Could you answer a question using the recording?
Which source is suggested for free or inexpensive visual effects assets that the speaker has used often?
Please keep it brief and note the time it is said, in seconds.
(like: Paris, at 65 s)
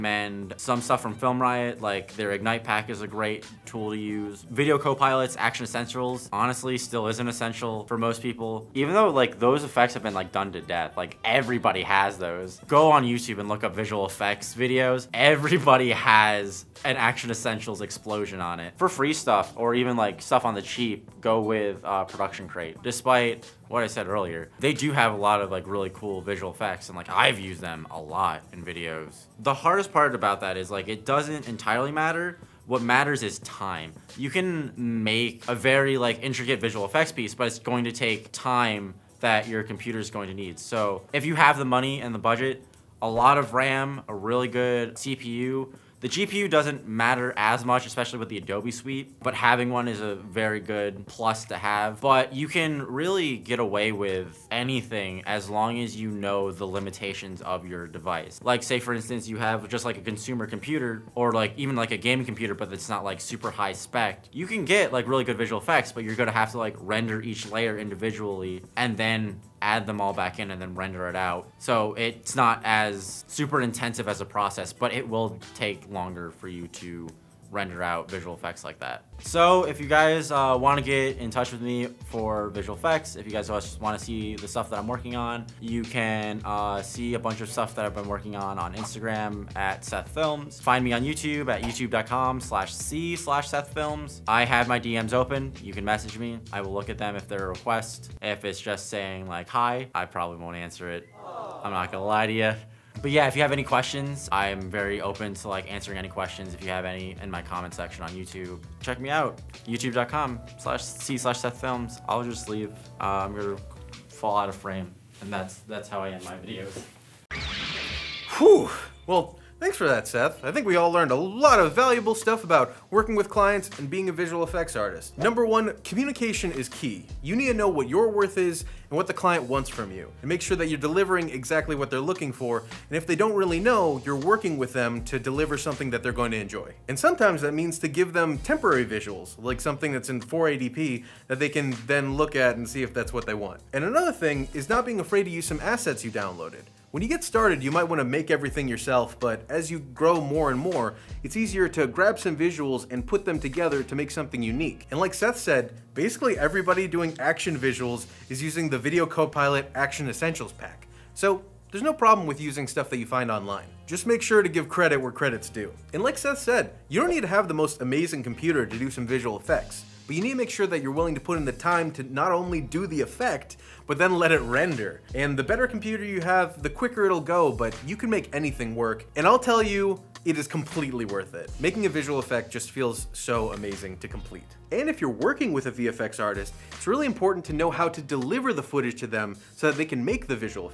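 Production Crate, at 22 s.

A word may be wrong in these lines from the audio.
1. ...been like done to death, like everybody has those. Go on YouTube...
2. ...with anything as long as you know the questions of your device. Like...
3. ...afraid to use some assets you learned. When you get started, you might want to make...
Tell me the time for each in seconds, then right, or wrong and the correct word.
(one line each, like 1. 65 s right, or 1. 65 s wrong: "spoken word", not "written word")
1. 10 s right
2. 53 s wrong: "limitations", not "questions"
3. 145 s wrong: "downloaded", not "learned".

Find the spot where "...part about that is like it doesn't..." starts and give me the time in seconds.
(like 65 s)
29 s.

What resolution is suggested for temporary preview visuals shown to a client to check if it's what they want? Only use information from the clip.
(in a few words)
480p.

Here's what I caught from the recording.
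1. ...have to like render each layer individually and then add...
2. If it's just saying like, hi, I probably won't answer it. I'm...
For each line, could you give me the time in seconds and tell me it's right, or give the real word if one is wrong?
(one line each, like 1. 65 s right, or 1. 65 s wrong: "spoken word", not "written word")
1. 66 s right
2. 98 s right.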